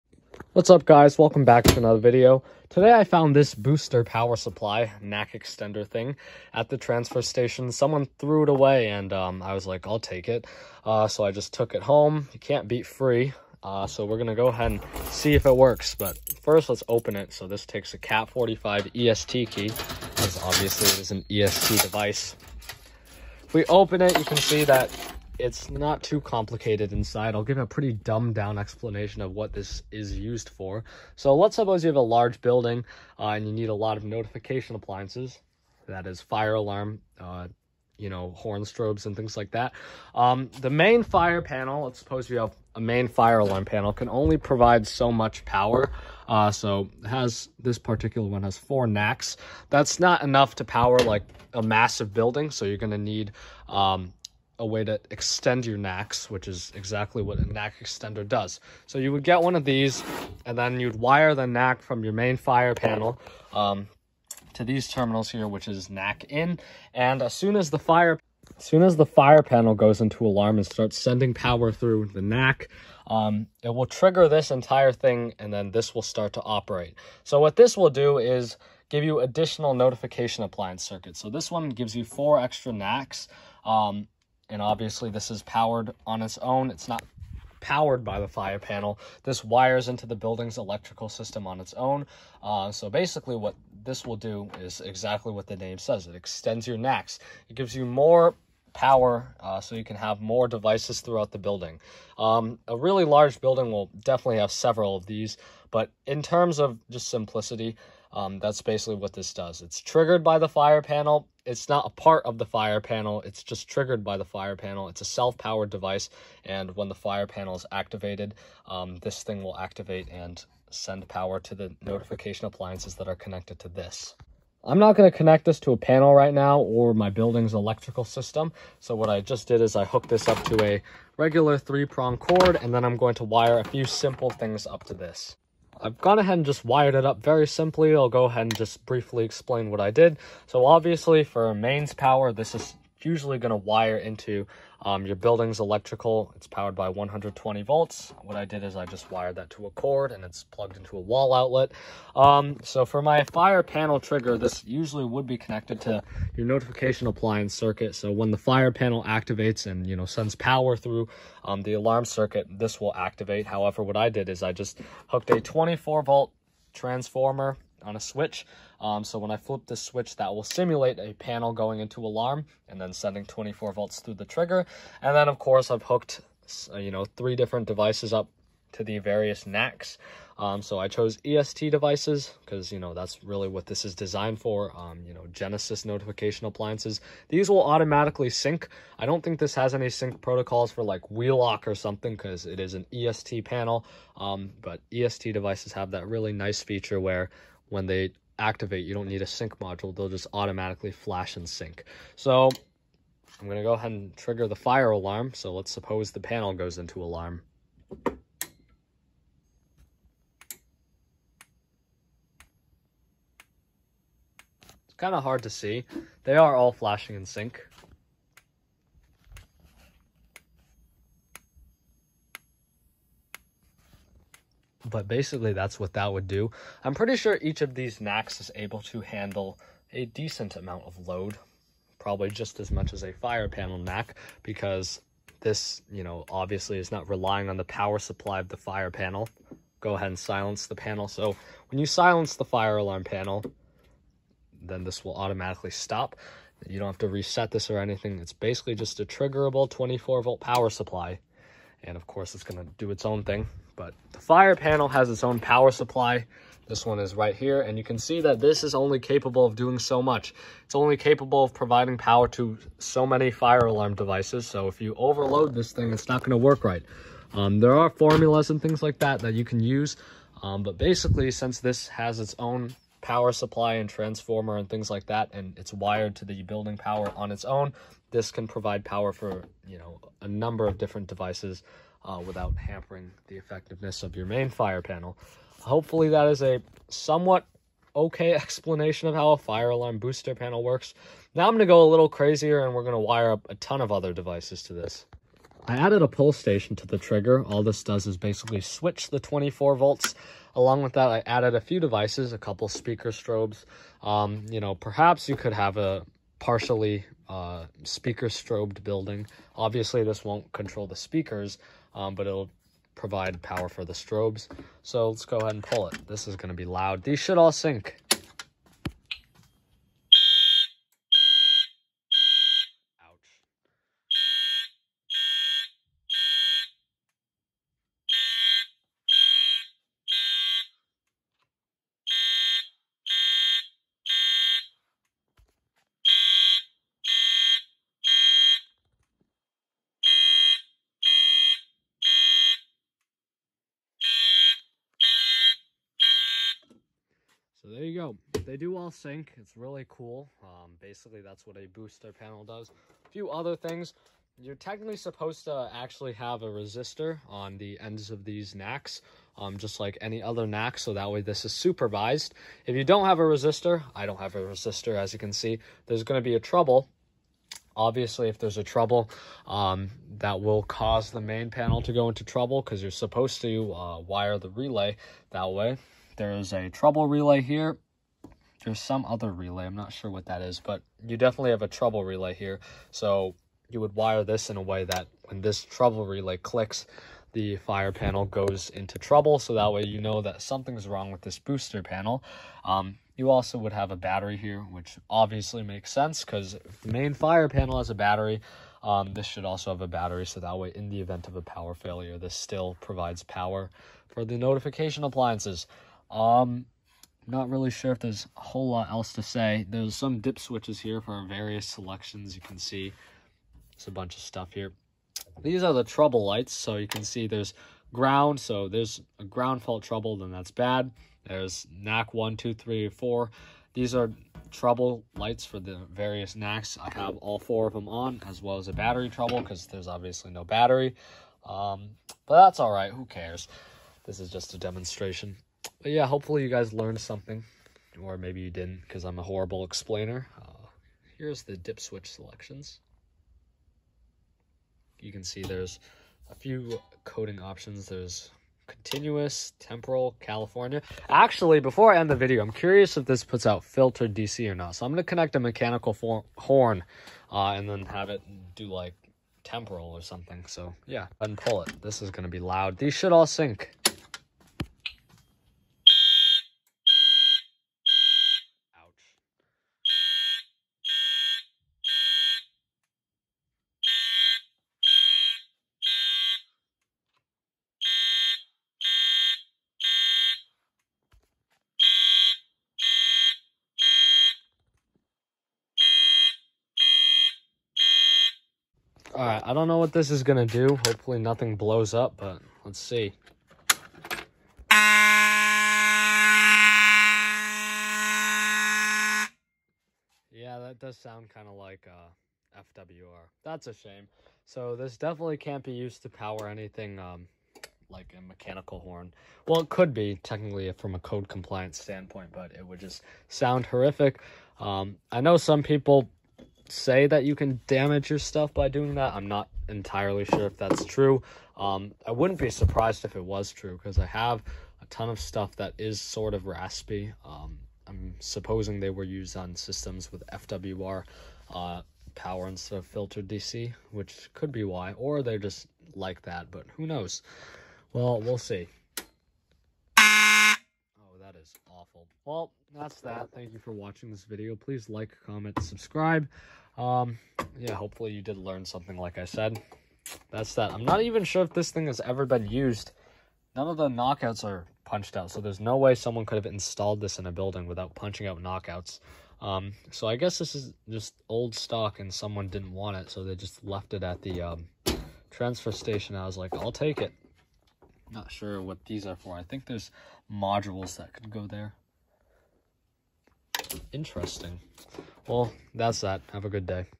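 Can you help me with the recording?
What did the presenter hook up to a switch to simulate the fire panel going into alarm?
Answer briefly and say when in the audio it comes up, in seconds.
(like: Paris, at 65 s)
24 volt transformer, at 165 s.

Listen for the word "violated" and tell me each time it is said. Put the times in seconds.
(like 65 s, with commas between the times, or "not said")
not said.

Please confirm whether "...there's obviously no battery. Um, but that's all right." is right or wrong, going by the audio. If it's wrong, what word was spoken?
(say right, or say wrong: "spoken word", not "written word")
right.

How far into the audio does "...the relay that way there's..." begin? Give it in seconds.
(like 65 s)
374 s.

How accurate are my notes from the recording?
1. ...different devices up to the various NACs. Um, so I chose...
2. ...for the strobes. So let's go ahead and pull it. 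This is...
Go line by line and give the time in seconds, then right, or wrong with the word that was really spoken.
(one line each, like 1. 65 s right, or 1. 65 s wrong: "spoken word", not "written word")
1. 177 s right
2. 313 s right.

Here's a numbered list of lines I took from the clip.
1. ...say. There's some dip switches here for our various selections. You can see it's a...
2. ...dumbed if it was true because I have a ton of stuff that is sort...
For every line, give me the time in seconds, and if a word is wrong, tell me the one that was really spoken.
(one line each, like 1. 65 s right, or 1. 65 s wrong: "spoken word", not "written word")
1. 409 s right
2. 522 s wrong: "surprised", not "dumbed".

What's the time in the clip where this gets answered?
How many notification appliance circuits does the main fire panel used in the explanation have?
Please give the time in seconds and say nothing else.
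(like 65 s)
48 s.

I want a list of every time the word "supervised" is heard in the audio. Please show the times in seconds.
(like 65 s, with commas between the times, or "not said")
361 s.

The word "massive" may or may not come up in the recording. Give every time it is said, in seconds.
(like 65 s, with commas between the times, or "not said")
51 s.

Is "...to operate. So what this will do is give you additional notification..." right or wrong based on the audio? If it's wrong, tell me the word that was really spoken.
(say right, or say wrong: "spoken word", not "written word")
right.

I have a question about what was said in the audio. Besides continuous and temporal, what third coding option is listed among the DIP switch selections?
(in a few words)
California.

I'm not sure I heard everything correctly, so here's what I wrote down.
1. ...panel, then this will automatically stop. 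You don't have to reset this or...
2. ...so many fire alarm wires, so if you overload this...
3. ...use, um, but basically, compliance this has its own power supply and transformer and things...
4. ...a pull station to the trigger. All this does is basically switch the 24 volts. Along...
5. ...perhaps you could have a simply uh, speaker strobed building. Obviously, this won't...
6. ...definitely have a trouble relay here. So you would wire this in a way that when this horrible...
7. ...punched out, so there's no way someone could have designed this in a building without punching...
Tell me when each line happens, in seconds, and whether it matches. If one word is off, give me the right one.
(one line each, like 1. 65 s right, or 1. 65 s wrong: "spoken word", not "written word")
1. 243 s right
2. 262 s wrong: "devices", not "wires"
3. 269 s wrong: "since", not "compliance"
4. 296 s right
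5. 304 s wrong: "partially", not "simply"
6. 381 s wrong: "trouble", not "horrible"
7. 554 s wrong: "installed", not "designed".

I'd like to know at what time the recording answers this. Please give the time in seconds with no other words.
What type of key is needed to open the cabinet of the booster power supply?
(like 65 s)
17 s.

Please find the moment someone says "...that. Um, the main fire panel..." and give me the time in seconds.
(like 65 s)
39 s.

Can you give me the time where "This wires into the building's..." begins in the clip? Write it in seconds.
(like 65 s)
89 s.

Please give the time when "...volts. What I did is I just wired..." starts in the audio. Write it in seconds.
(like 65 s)
147 s.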